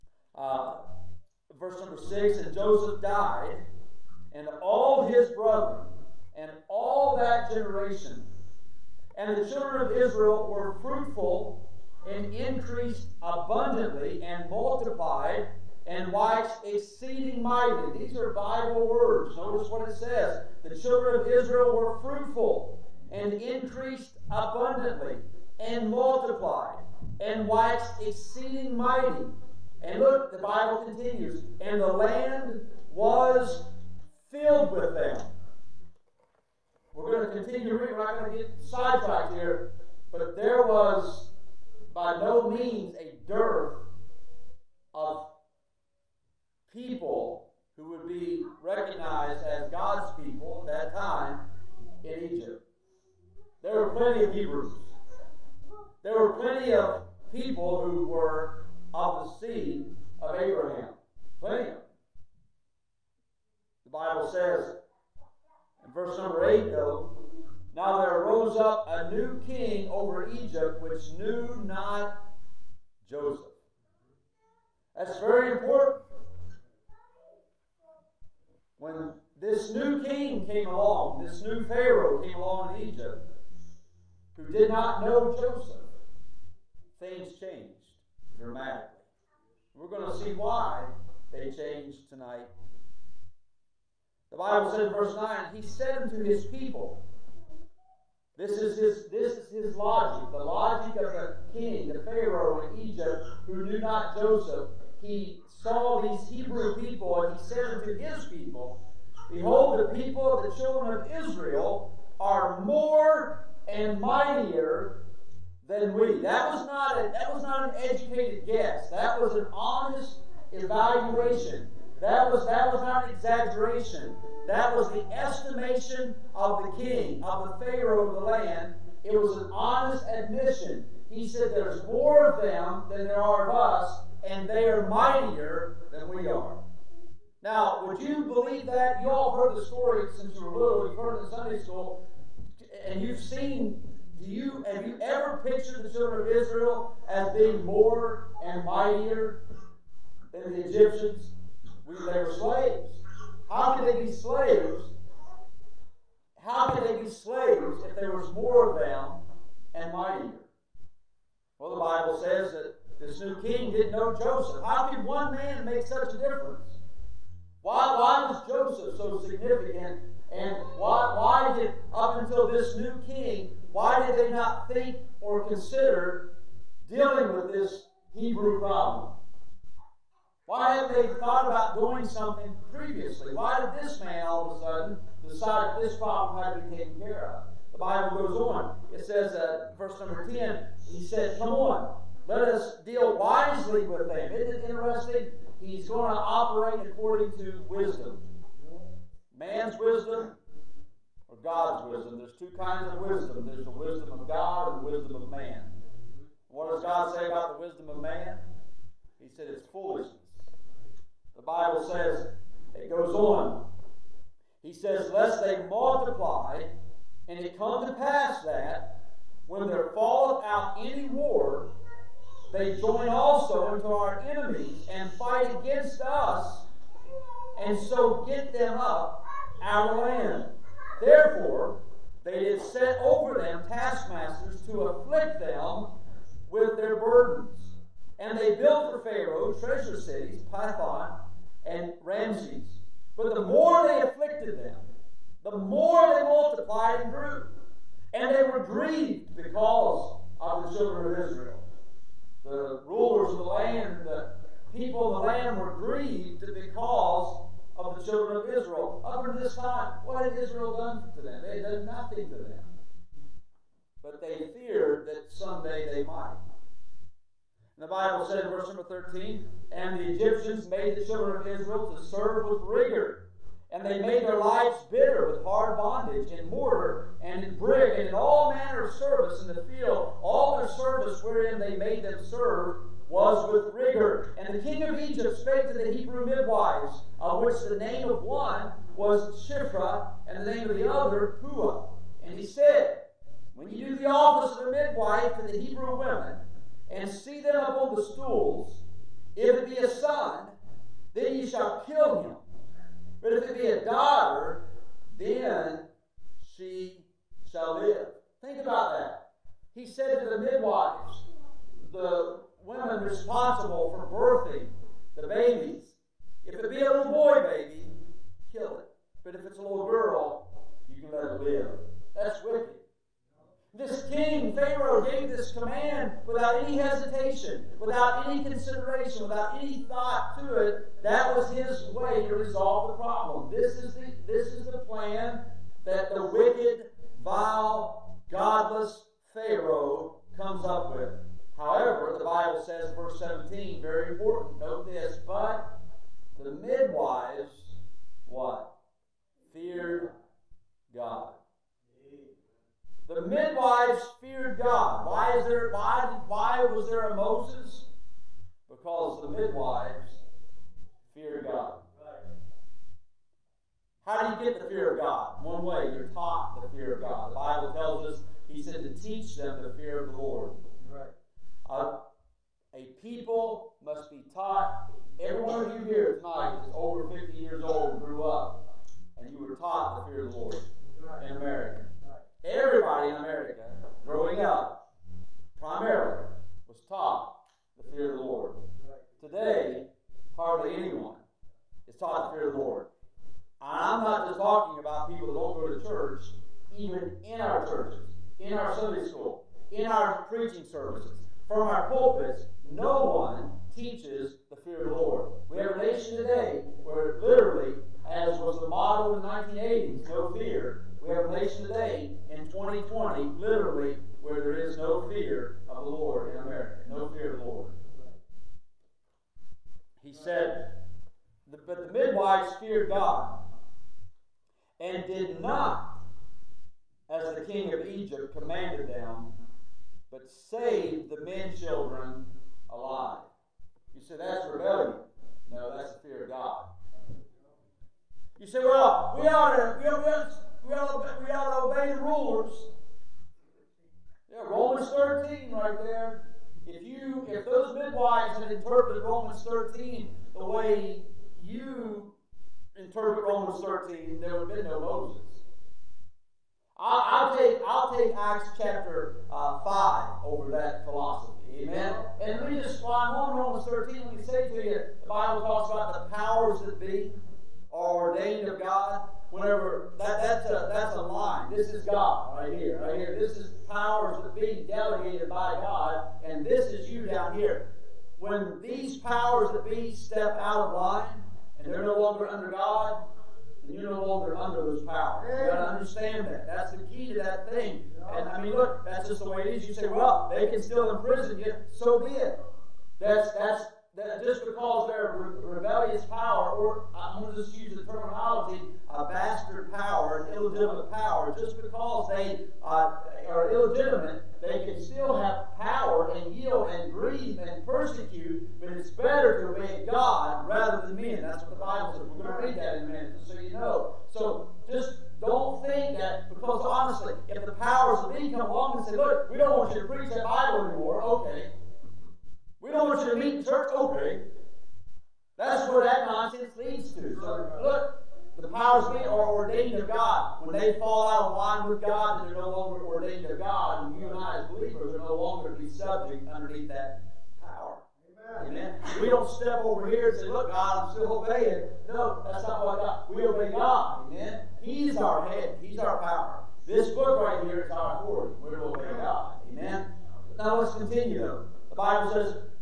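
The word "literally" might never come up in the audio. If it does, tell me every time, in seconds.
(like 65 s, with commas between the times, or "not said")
407 s, 413 s.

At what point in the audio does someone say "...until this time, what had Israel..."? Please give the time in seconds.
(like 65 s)
259 s.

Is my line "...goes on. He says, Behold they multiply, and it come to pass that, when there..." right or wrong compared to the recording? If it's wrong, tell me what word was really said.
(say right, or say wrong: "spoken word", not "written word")
wrong: "Lest", not "Behold".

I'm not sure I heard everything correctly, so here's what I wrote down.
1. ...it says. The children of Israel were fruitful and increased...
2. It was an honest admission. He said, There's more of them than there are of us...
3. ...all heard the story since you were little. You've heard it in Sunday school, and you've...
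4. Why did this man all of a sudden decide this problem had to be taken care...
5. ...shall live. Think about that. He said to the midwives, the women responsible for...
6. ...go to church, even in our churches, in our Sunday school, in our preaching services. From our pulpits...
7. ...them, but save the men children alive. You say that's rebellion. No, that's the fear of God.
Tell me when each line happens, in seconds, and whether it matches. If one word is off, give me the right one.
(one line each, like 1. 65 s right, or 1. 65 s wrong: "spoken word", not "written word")
1. 19 s right
2. 129 s right
3. 139 s right
4. 183 s right
5. 307 s right
6. 395 s right
7. 428 s right.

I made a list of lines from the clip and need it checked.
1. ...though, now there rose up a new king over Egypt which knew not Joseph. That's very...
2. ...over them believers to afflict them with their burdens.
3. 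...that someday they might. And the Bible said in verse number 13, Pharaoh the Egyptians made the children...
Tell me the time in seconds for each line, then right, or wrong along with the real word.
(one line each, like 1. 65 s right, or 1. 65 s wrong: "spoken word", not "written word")
1. 66 s right
2. 232 s wrong: "taskmasters", not "believers"
3. 265 s wrong: "And", not "Pharaoh".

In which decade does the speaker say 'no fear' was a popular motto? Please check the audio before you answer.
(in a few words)
1980s.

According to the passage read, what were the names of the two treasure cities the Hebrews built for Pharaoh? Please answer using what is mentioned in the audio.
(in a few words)
Pithom and Ramses.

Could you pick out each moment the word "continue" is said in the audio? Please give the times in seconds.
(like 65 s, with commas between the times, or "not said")
30 s, 37 s, 550 s.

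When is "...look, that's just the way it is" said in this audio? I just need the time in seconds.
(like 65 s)
488 s.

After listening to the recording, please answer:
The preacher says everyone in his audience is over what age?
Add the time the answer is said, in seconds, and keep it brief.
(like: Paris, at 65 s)
50, at 377 s.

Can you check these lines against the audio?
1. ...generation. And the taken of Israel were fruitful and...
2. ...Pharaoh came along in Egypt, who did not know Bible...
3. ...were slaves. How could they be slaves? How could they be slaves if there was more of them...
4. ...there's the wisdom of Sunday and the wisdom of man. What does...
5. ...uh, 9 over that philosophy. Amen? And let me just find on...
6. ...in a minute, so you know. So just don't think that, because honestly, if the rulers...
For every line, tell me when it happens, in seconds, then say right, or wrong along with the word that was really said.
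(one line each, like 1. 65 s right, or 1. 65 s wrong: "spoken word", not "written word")
1. 7 s wrong: "children", not "taken"
2. 81 s wrong: "Joseph", not "Bible"
3. 152 s right
4. 203 s wrong: "God", not "Sunday"
5. 459 s wrong: "5", not "9"
6. 512 s wrong: "powers", not "rulers".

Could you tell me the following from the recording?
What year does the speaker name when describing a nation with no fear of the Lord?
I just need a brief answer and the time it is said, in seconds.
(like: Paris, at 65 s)
2020, at 412 s.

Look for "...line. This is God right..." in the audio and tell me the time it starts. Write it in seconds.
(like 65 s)
471 s.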